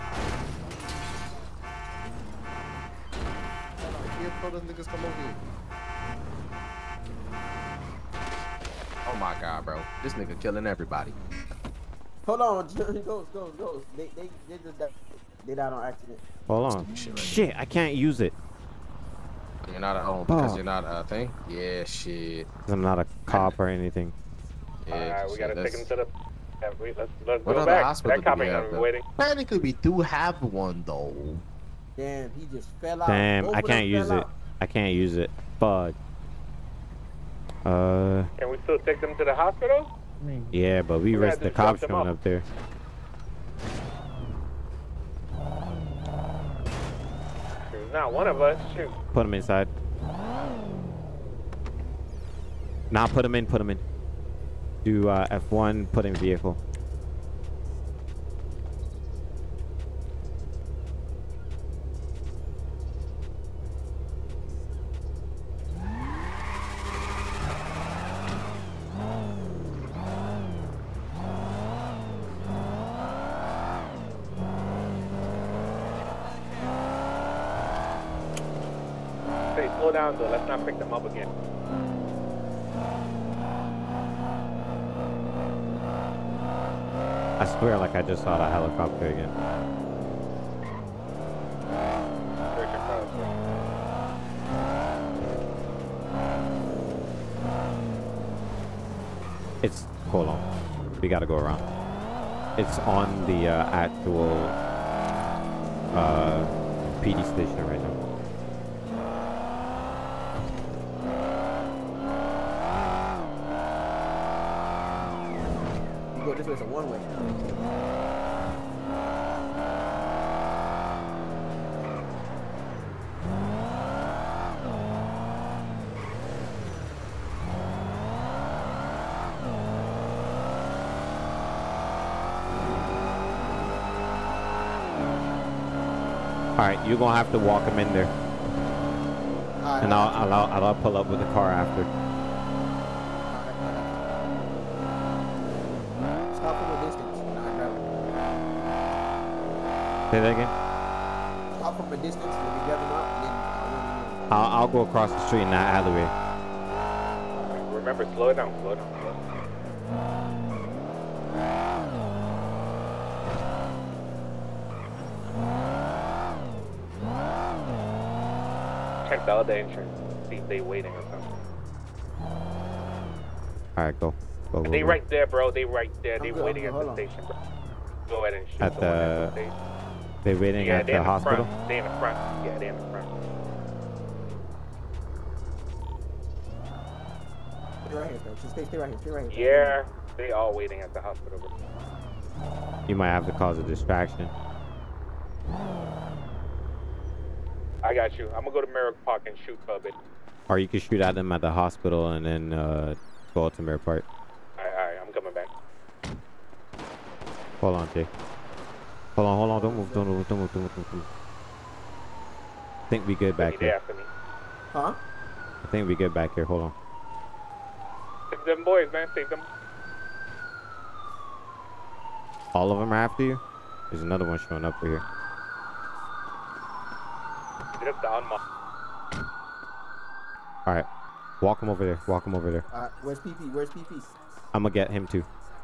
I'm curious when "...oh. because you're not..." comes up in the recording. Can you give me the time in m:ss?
0:20.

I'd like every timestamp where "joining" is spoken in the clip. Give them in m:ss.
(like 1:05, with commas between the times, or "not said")
not said.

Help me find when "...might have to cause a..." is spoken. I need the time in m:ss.
3:12.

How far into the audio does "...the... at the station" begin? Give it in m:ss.
2:58.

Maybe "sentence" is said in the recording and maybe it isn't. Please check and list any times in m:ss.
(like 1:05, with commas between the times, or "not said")
not said.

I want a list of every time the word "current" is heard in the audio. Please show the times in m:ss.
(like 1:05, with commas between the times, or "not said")
not said.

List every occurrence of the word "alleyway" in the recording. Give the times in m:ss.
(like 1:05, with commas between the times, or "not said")
2:35.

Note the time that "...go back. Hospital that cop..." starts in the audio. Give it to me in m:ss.
0:27.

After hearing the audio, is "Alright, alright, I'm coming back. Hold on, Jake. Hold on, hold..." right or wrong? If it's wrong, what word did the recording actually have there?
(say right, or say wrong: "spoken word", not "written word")
right.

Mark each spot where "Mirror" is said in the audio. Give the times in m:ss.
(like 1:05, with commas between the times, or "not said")
3:18, 3:23.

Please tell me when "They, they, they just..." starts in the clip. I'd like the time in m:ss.
0:13.